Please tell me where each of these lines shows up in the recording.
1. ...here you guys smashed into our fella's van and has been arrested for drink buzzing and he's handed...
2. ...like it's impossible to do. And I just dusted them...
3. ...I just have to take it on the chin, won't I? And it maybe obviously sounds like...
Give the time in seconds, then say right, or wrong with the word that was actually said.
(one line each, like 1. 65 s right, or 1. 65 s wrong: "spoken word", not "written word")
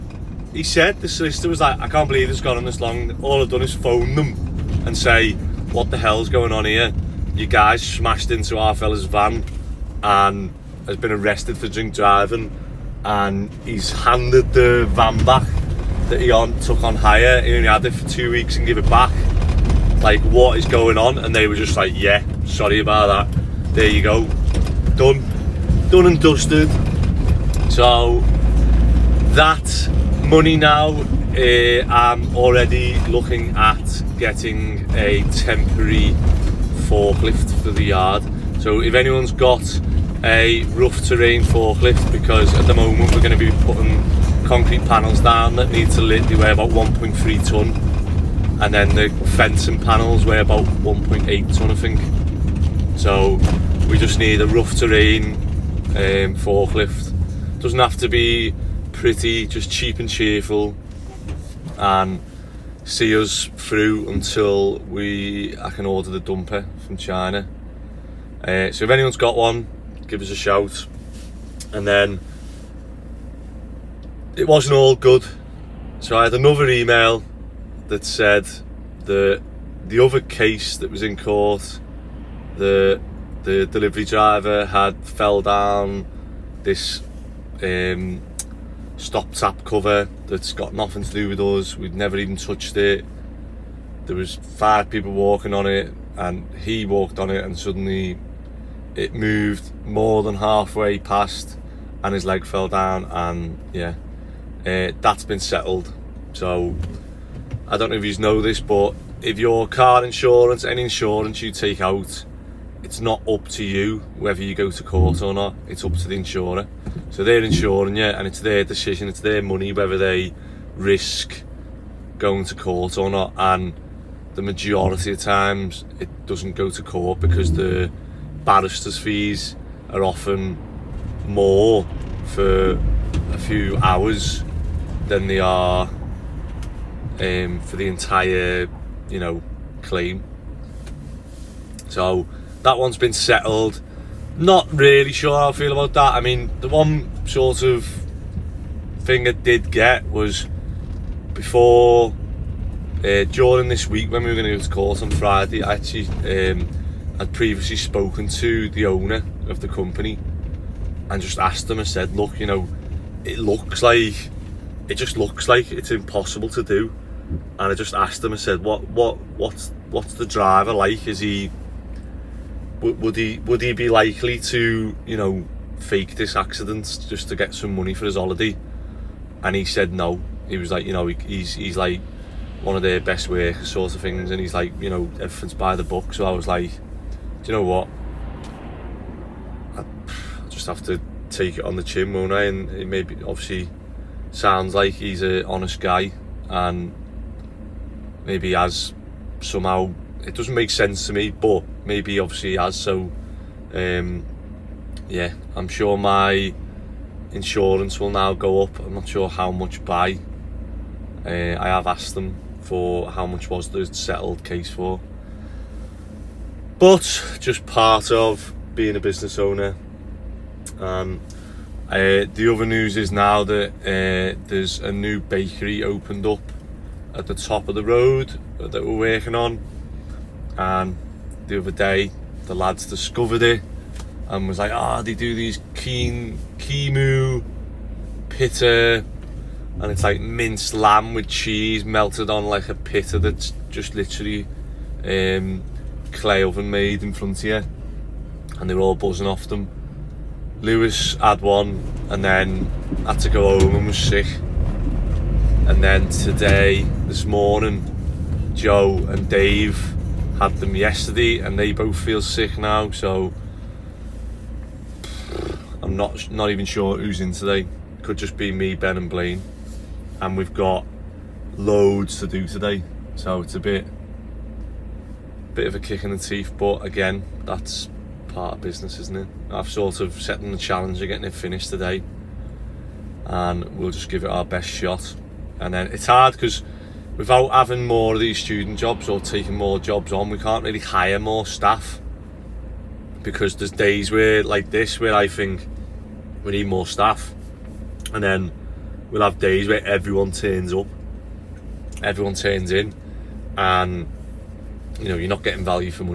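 1. 6 s wrong: "driving", not "buzzing"
2. 165 s wrong: "asked", not "dusted"
3. 189 s right.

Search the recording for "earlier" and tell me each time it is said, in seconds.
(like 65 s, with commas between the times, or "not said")
not said.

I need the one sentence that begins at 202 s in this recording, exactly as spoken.
So, um, yeah, I'm sure my insurance will now go up.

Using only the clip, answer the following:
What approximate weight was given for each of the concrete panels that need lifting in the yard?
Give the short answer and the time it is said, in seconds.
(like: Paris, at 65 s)
1.3 ton, at 46 s.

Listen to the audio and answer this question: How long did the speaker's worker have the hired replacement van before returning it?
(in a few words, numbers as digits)
2 weeks.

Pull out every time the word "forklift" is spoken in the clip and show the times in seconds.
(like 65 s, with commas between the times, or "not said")
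36 s, 41 s, 56 s.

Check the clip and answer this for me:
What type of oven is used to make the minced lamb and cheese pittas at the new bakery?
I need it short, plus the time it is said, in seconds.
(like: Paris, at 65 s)
clay oven, at 246 s.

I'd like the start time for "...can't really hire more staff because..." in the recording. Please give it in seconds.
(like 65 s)
290 s.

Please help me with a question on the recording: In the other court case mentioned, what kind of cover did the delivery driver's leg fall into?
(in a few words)
stop tap cover.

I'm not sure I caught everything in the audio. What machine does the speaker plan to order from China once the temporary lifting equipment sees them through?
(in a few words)
dumper.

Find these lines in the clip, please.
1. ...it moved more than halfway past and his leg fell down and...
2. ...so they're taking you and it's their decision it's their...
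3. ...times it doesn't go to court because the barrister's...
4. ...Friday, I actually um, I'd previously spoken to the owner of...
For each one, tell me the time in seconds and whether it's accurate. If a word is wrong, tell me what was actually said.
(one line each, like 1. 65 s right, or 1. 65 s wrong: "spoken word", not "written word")
1. 98 s right
2. 117 s wrong: "insuring", not "taking"
3. 125 s right
4. 155 s right.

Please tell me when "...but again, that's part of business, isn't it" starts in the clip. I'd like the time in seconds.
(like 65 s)
276 s.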